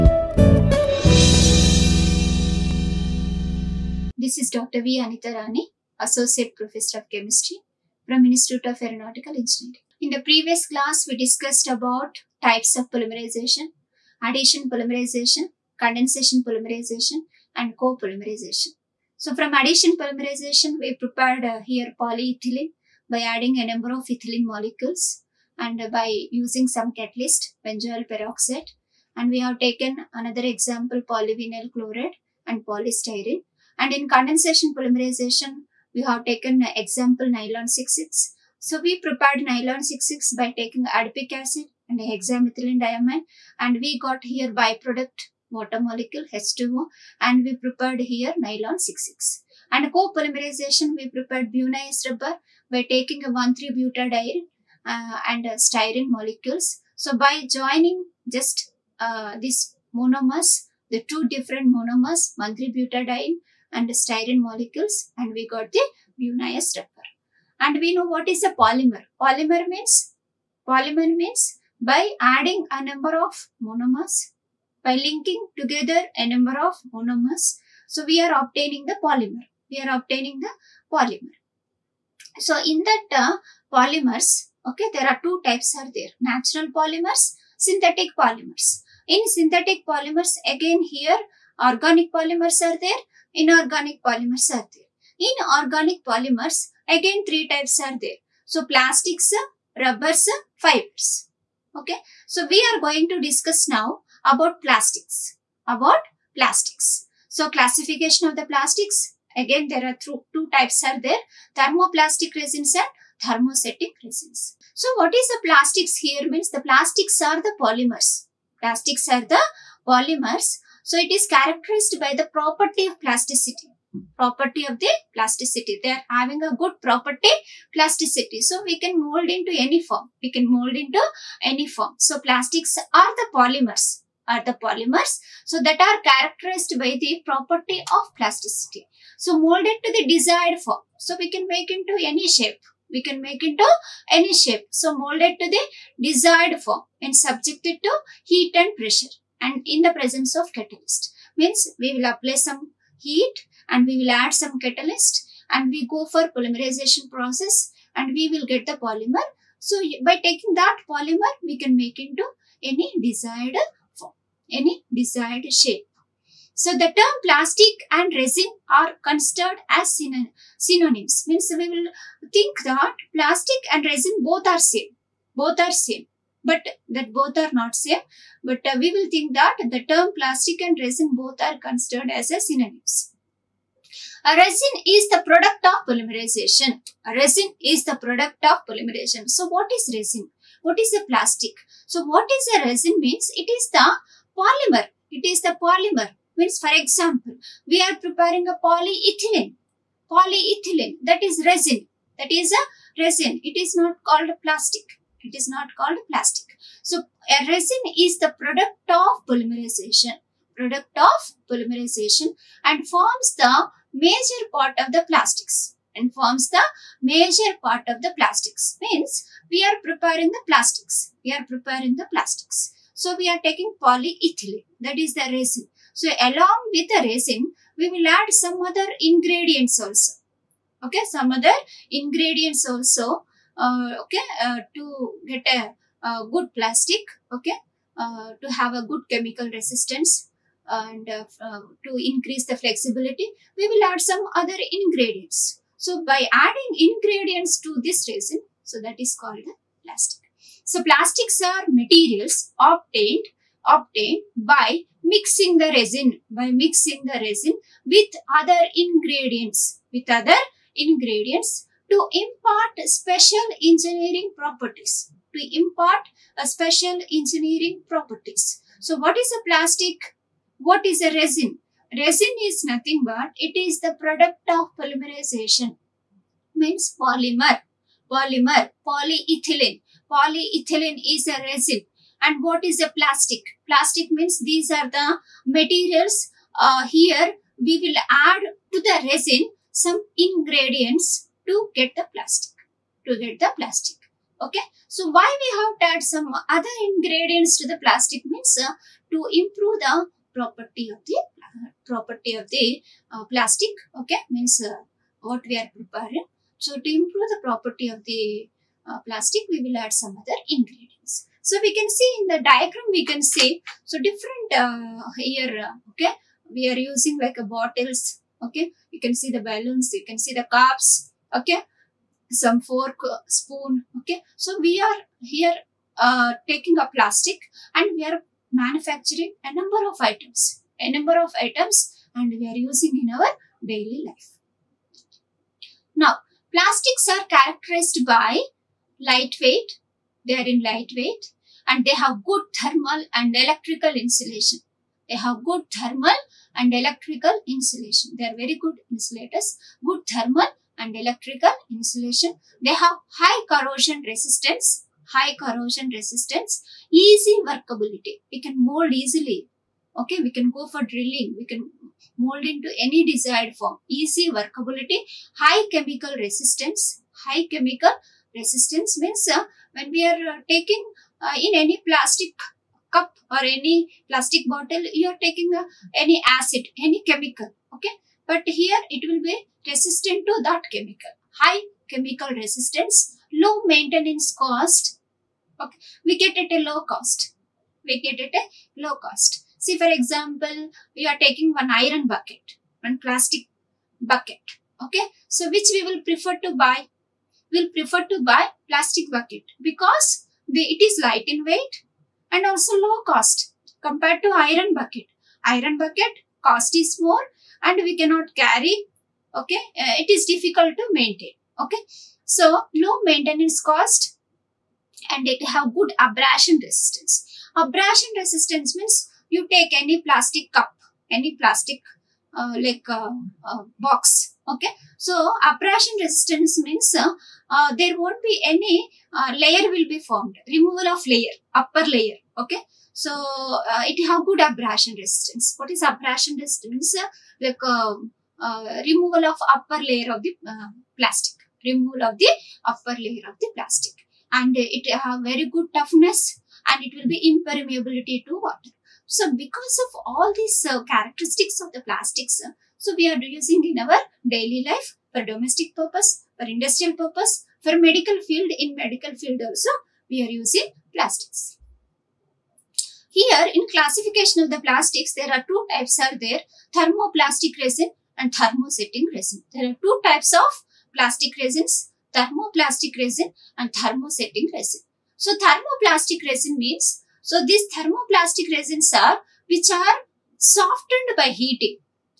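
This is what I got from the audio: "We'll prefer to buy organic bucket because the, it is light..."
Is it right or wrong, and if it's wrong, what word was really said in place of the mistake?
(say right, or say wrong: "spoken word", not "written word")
wrong: "plastic", not "organic".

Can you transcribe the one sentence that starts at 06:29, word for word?
See, for example, we are taking one iron bucket, one plastic bucket.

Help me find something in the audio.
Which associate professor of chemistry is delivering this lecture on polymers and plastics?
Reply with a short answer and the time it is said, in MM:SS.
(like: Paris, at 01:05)
Dr. V. Anitha, at 00:04.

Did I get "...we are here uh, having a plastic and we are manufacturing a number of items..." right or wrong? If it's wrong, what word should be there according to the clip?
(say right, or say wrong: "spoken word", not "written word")
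wrong: "taking", not "having".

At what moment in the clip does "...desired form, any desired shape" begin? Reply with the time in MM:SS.
02:43.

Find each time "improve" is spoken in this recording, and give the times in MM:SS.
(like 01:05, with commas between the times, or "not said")
04:59, 05:06.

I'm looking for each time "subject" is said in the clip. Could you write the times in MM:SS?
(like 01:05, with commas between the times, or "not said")
02:27.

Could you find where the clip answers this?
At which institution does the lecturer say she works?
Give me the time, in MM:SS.
00:08.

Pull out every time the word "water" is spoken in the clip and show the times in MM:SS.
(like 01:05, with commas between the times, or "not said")
00:45, 07:28.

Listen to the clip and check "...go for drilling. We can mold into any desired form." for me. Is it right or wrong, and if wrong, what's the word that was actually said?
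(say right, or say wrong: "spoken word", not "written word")
right.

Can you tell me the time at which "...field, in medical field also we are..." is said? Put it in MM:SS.
07:38.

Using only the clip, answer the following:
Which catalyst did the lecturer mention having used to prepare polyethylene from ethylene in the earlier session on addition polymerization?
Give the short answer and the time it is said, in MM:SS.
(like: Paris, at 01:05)
Benzoyl peroxide, at 00:27.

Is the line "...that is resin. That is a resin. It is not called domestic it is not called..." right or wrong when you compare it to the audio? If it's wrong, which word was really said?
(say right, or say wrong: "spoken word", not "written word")
wrong: "plastic", not "domestic".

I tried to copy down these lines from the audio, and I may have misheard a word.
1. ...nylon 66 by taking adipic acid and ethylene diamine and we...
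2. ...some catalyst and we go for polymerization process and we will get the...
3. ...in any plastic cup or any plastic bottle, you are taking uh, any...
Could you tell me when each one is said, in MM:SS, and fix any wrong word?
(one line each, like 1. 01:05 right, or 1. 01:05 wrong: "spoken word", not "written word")
1. 00:39 wrong: "hexamethylene", not "ethylene"
2. 02:34 right
3. 06:11 right.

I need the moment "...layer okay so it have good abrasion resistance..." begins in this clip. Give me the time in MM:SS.
07:11.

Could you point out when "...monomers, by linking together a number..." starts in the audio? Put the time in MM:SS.
01:13.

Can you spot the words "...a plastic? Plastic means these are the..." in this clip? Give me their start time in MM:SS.
04:42.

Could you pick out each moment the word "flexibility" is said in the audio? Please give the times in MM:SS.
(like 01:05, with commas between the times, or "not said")
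04:02.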